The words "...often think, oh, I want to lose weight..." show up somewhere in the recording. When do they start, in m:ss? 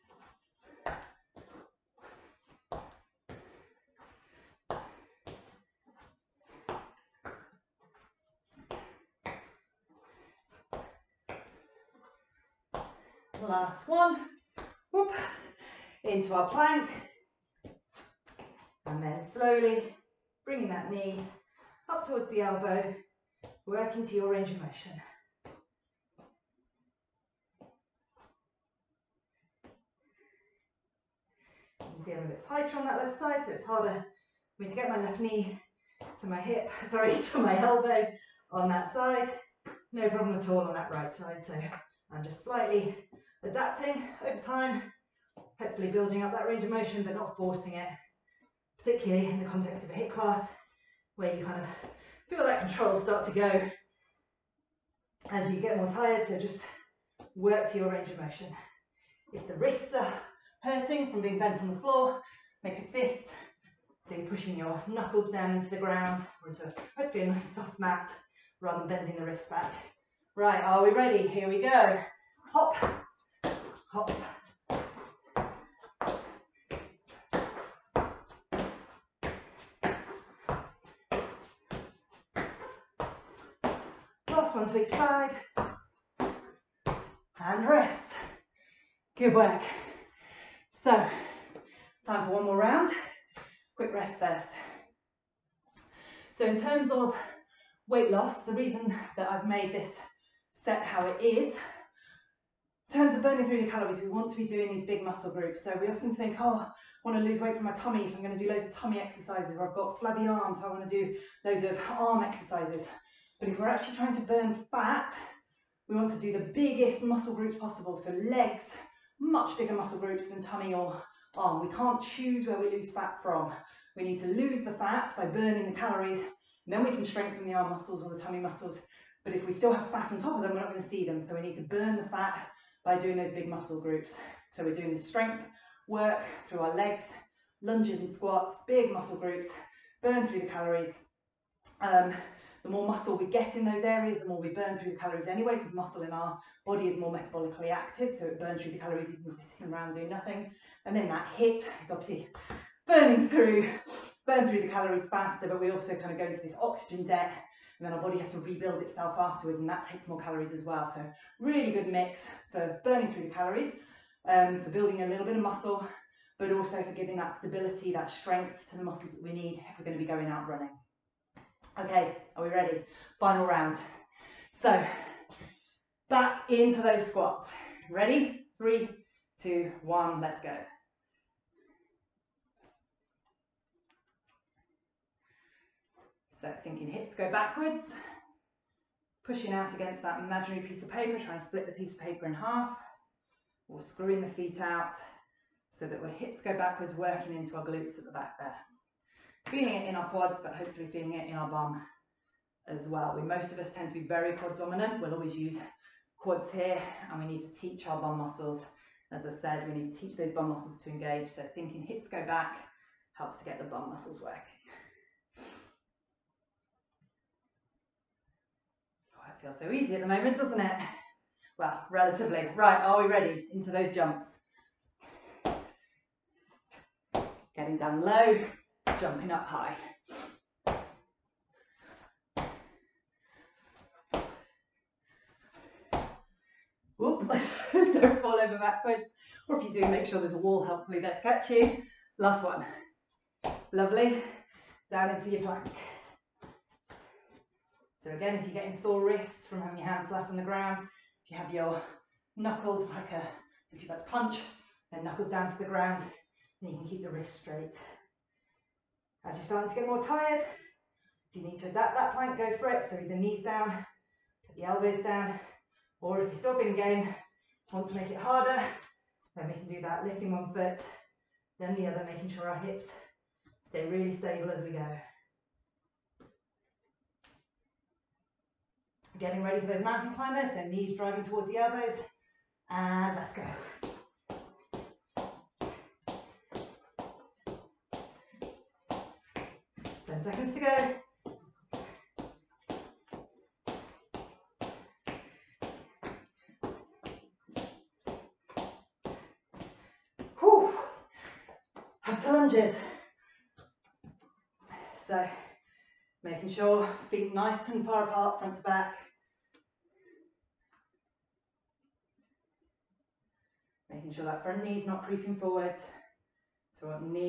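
1:45.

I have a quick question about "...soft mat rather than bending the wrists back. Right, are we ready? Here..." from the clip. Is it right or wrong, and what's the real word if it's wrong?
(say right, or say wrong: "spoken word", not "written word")
right.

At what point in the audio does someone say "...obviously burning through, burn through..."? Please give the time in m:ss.
2:31.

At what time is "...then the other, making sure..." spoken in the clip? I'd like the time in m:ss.
4:31.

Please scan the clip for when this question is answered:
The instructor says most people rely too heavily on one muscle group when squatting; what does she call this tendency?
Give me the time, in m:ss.
3:24.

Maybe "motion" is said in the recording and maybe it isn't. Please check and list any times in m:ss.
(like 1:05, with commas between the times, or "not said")
0:24, 0:46, 0:58.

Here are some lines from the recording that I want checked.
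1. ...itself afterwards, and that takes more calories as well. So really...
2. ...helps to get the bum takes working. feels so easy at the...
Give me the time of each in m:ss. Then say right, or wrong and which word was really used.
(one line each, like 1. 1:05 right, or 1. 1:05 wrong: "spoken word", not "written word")
1. 2:38 right
2. 3:33 wrong: "muscles", not "takes".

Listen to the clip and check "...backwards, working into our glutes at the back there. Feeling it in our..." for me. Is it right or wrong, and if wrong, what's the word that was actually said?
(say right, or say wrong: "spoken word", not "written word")
right.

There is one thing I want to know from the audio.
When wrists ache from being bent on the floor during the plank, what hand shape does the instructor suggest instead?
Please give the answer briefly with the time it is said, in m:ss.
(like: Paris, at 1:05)
a fist, at 1:02.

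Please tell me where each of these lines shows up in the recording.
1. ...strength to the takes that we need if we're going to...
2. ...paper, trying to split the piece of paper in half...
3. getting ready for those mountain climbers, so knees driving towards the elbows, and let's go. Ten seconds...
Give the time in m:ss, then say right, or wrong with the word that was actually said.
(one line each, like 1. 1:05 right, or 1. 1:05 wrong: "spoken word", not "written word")
1. 2:48 wrong: "muscles", not "takes"
2. 3:10 right
3. 4:39 right.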